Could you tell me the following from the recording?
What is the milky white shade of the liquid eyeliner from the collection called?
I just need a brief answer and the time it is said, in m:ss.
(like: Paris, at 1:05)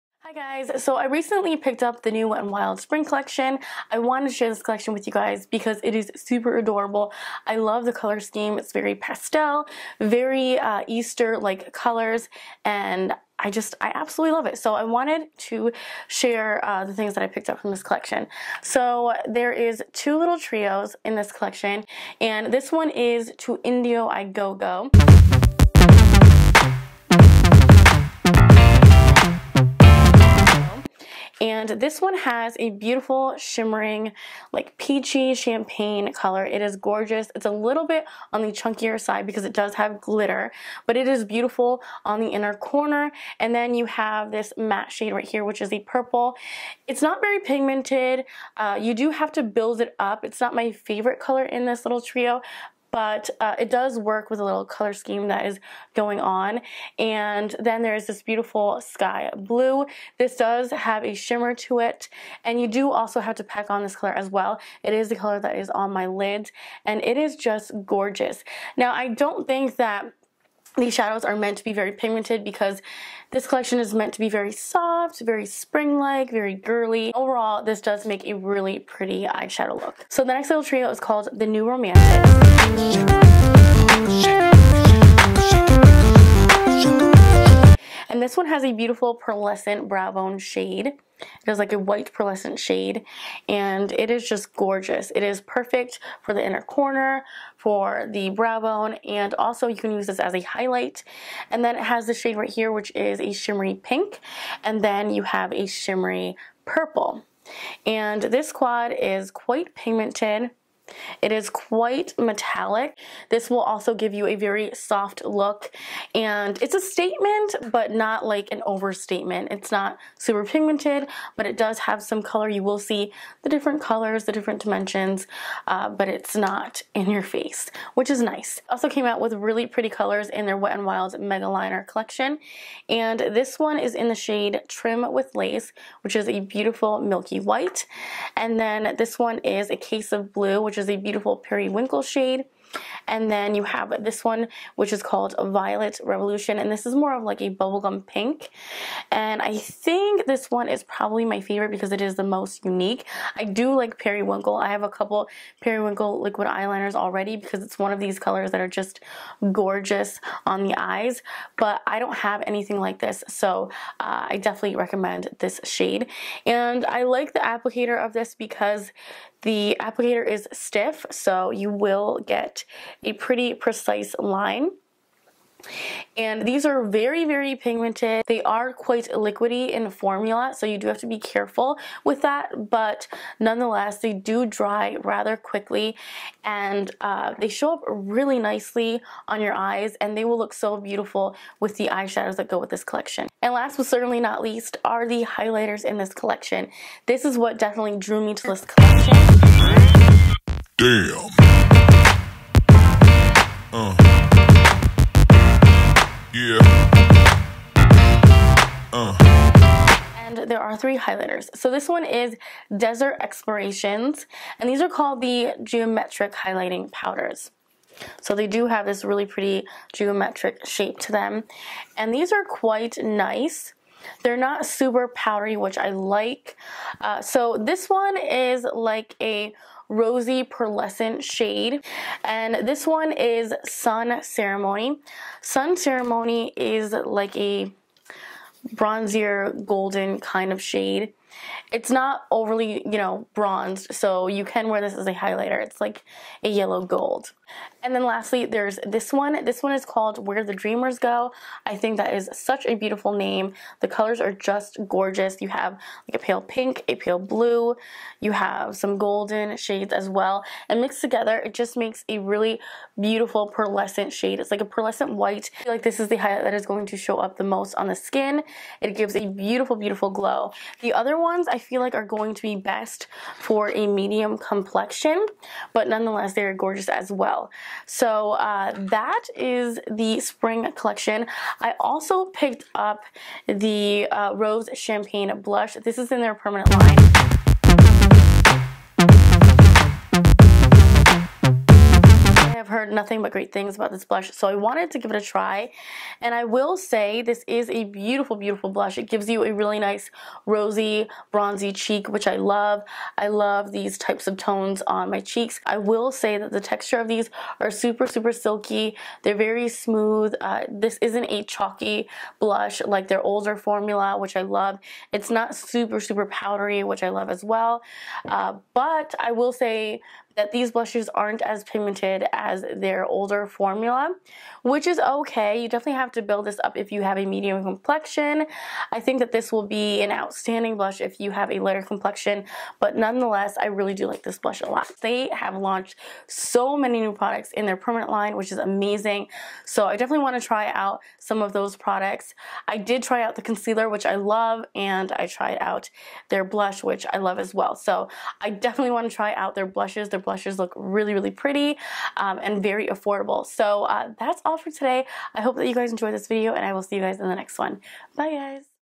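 Trim with Lace, at 2:14.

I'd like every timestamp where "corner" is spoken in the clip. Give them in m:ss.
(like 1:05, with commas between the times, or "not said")
0:42, 1:36.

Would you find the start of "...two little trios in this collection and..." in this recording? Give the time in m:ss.
0:19.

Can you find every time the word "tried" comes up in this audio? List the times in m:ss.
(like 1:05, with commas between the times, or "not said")
5:45.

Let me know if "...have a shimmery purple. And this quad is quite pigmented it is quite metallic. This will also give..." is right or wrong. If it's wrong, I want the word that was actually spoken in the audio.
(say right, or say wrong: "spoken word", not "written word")
right.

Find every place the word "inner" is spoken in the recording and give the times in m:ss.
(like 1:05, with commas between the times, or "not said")
0:42, 1:36.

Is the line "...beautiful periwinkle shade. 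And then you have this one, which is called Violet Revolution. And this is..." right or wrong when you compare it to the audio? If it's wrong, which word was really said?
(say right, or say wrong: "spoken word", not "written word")
right.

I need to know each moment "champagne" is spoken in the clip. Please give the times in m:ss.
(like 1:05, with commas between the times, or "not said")
0:35, 4:44.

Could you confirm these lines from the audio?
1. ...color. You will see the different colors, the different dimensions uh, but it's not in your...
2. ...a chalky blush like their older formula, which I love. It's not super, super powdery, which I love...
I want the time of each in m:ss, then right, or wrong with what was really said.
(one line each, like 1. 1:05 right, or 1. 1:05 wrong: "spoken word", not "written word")
1. 2:02 right
2. 5:11 right.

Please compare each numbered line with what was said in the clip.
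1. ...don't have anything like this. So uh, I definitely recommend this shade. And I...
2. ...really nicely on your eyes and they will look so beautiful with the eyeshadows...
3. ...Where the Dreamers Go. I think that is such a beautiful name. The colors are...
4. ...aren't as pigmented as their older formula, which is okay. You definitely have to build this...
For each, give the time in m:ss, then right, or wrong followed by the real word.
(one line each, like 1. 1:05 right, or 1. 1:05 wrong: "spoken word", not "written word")
1. 2:41 right
2. 3:07 right
3. 4:10 right
4. 5:21 right.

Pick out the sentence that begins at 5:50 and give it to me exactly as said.
Their blushes look really, really pretty um, and very affordable.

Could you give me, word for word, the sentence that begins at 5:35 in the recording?
They have launched so many new products in their permanent line, which is amazing.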